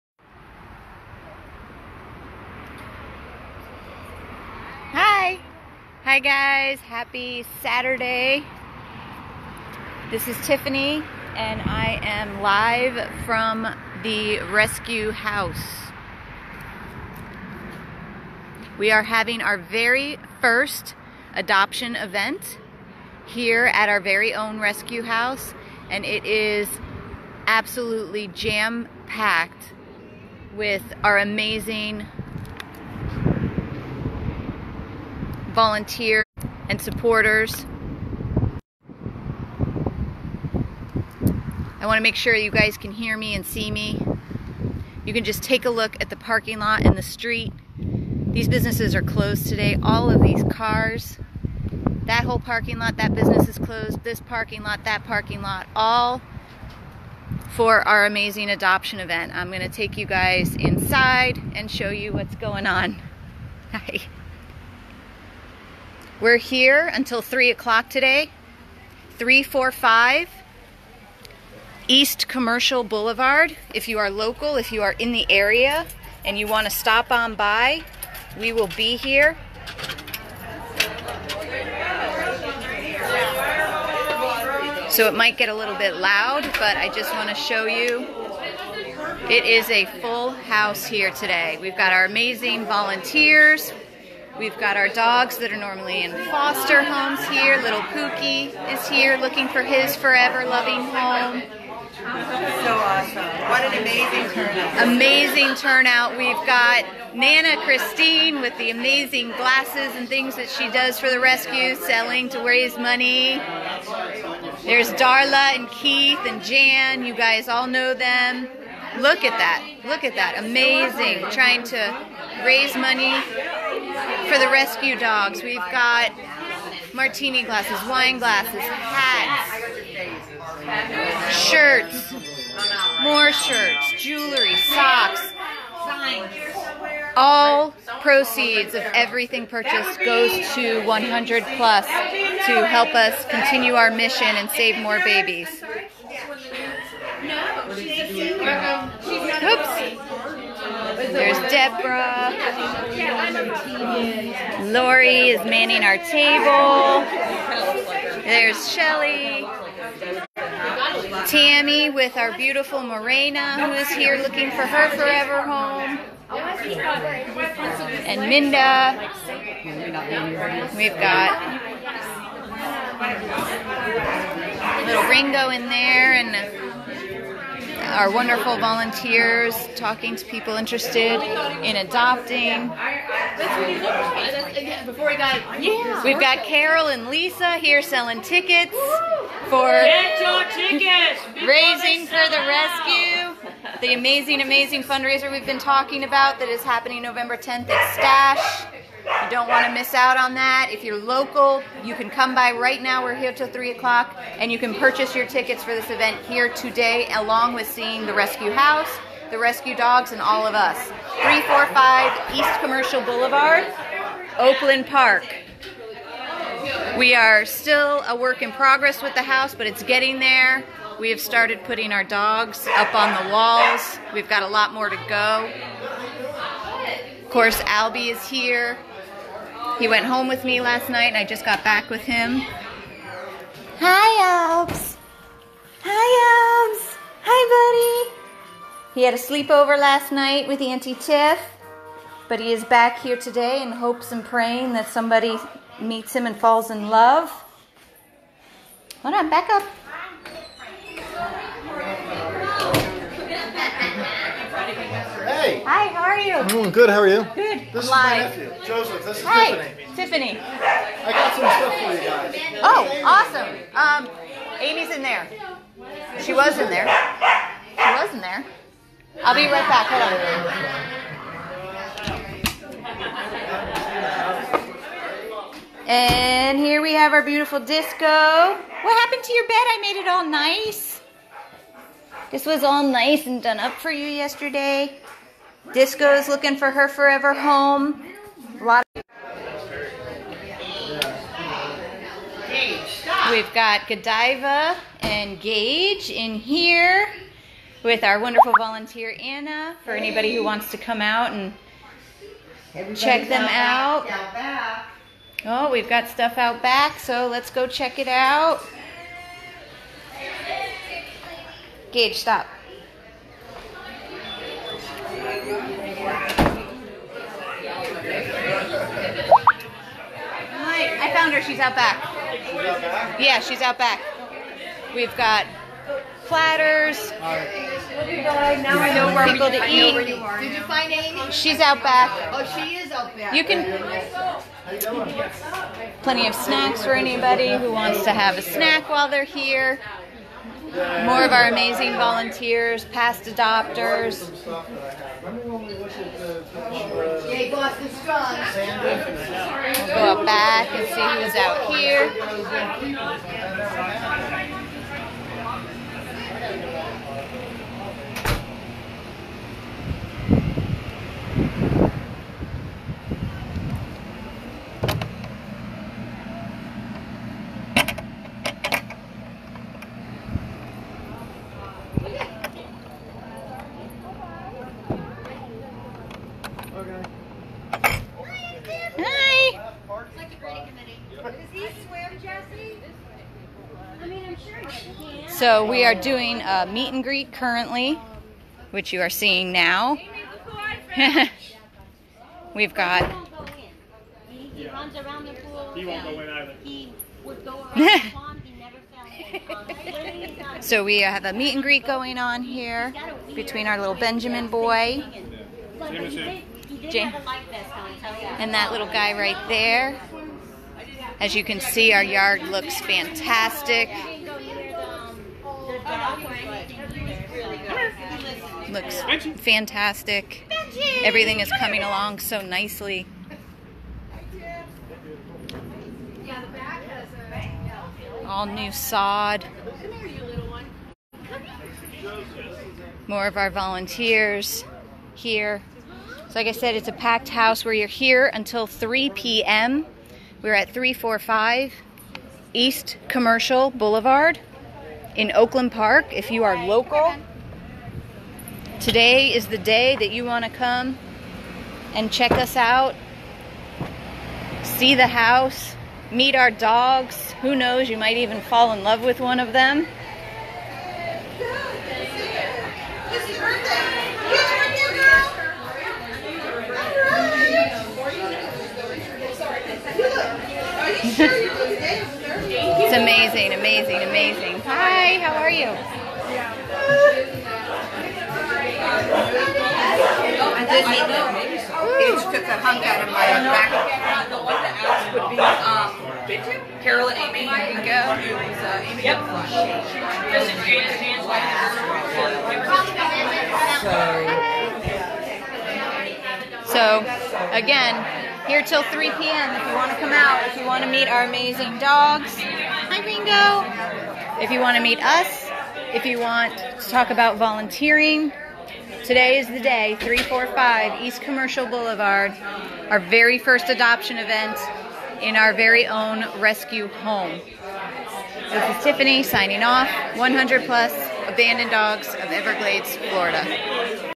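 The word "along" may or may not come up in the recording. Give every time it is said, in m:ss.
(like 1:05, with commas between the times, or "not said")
3:27, 7:01.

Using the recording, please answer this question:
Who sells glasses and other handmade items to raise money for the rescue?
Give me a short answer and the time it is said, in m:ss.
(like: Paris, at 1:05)
Nana Christine, at 1:47.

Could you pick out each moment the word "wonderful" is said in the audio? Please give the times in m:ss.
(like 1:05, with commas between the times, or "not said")
2:58, 4:58.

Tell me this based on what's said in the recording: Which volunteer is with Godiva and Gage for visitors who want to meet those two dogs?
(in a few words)
Anna.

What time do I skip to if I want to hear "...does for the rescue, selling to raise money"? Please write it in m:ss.
1:50.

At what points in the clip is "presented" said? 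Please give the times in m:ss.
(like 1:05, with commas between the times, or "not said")
not said.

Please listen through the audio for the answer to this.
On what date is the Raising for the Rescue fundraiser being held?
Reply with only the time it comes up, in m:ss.
3:17.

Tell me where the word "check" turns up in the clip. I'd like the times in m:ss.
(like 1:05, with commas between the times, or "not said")
5:02, 5:07, 7:32.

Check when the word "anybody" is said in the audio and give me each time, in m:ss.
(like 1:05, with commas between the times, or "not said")
4:59, 5:36.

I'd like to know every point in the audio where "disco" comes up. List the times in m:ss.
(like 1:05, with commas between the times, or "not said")
4:37, 4:45.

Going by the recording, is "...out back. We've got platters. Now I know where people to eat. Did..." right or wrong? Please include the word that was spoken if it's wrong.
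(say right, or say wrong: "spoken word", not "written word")
right.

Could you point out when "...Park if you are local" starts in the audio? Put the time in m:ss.
7:25.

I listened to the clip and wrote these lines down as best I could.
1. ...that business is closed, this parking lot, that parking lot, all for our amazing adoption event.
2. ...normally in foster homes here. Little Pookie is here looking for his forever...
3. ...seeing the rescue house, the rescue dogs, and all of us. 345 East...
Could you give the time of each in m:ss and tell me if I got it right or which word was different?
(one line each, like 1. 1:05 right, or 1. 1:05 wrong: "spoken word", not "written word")
1. 0:52 right
2. 1:35 right
3. 3:27 right.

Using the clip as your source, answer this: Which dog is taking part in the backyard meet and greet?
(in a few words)
Benjamin.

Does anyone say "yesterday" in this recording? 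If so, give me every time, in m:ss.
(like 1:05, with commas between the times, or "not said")
4:44.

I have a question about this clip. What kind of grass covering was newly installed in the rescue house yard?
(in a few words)
sod.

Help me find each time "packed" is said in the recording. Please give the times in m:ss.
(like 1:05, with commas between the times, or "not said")
0:28, 7:16.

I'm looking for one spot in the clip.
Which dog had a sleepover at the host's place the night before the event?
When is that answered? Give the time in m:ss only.
3:47.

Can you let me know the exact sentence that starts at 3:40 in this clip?
We have started putting our dogs up on the walls.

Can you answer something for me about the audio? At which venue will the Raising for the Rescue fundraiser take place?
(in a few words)
Stash.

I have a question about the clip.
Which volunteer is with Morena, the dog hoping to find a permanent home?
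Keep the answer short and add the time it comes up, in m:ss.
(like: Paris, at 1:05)
Tammy, at 2:41.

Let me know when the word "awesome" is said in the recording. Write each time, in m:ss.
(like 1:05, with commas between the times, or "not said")
1:42, 4:23.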